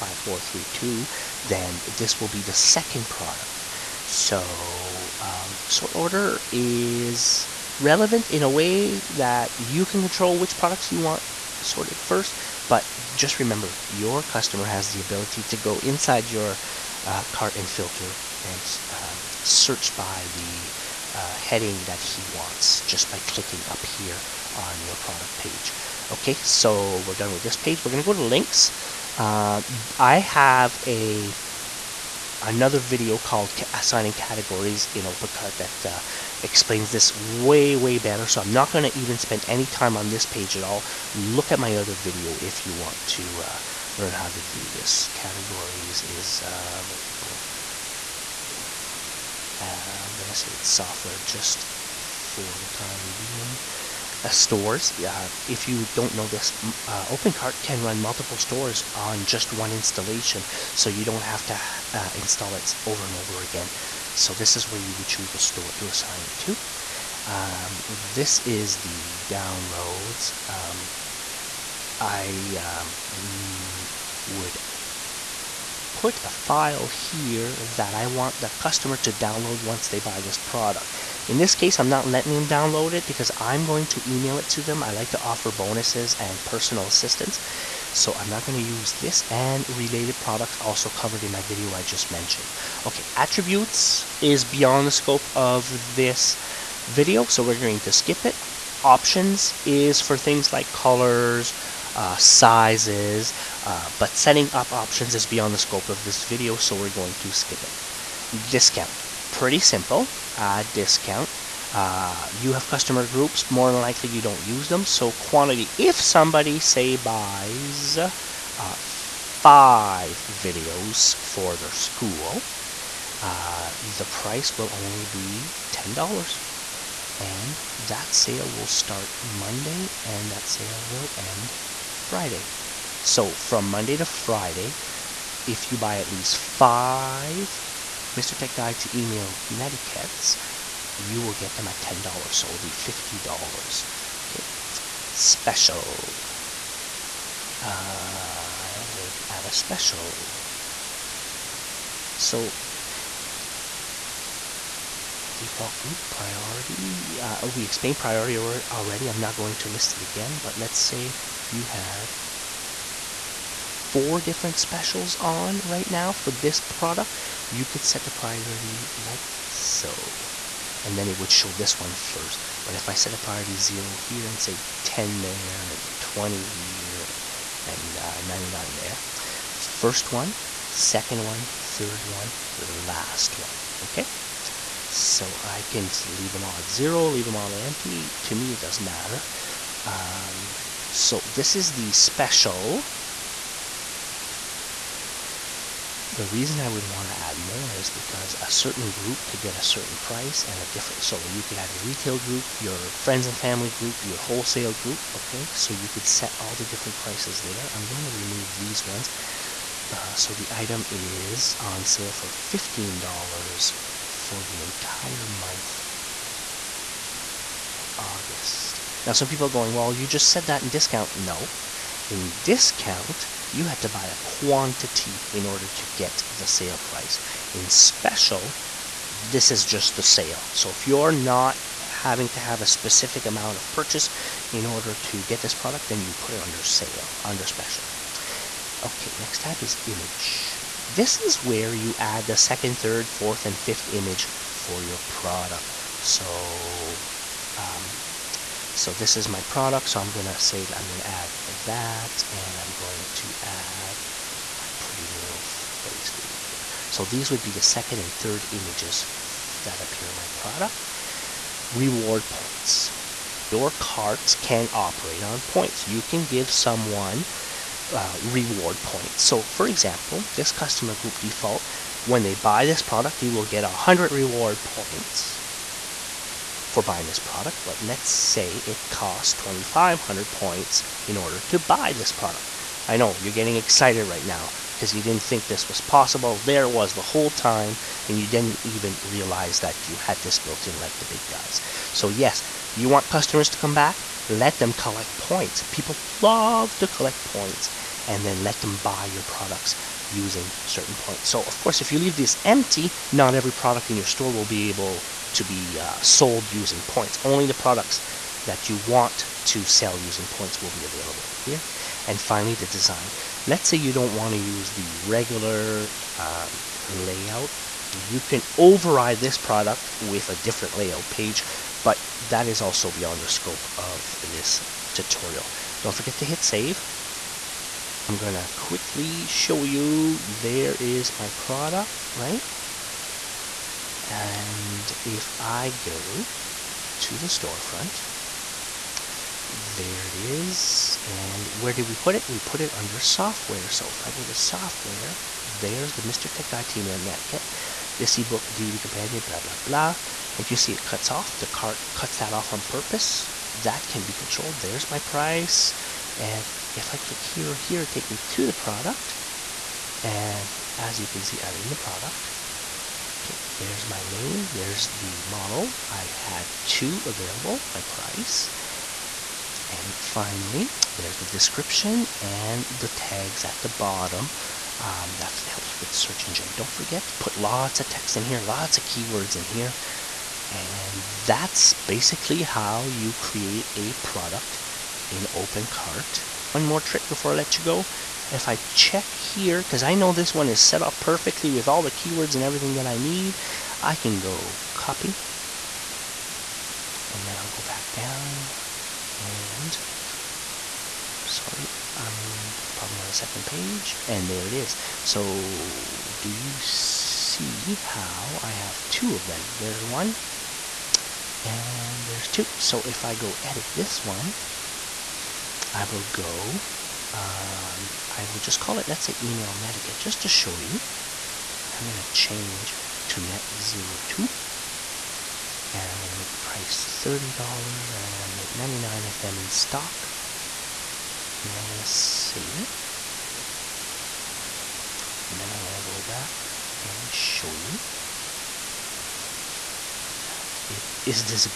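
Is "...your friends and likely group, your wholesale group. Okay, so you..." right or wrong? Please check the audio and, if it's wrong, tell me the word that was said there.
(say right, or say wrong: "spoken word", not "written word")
wrong: "family", not "likely".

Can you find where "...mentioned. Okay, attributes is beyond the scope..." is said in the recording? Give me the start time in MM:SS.
01:32.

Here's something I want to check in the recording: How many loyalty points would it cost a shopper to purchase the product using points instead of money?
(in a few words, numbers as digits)
2,500.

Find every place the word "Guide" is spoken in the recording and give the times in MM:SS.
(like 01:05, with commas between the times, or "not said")
02:18, 05:46.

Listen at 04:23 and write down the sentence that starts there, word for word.
Your cart can operate on points.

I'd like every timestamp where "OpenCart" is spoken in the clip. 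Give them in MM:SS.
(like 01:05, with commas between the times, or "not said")
00:35, 00:57, 06:25.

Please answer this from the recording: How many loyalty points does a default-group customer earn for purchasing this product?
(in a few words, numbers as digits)
100.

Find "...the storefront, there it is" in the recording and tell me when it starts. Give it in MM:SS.
05:37.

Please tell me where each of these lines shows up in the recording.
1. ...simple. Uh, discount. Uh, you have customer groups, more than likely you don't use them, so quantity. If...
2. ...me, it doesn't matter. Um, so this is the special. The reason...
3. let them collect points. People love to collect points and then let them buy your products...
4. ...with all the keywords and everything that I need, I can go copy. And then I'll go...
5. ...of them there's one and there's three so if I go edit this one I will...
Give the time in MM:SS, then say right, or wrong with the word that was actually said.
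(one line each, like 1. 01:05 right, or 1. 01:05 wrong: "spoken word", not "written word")
1. 01:49 right
2. 03:08 right
3. 04:54 right
4. 06:31 right
5. 06:49 wrong: "two", not "three".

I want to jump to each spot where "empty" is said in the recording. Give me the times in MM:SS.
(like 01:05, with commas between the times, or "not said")
03:07, 05:02.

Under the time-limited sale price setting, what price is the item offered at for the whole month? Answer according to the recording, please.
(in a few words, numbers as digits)
$15.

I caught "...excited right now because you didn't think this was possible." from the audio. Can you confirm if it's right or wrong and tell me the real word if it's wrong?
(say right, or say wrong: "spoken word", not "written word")
right.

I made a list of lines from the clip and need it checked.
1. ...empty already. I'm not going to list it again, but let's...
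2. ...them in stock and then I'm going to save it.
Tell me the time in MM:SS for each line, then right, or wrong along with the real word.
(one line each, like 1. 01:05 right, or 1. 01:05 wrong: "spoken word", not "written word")
1. 02:37 wrong: "priority", not "empty"
2. 07:09 right.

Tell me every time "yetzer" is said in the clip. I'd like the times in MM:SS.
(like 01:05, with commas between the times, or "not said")
not said.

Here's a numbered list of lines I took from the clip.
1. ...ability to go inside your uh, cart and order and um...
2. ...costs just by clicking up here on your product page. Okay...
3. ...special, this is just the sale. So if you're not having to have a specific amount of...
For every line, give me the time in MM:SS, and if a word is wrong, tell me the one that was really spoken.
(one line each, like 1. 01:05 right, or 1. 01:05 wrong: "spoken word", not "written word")
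1. 00:14 wrong: "filter", not "order"
2. 00:22 wrong: "wants", not "costs"
3. 03:47 right.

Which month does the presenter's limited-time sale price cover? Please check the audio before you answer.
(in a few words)
August.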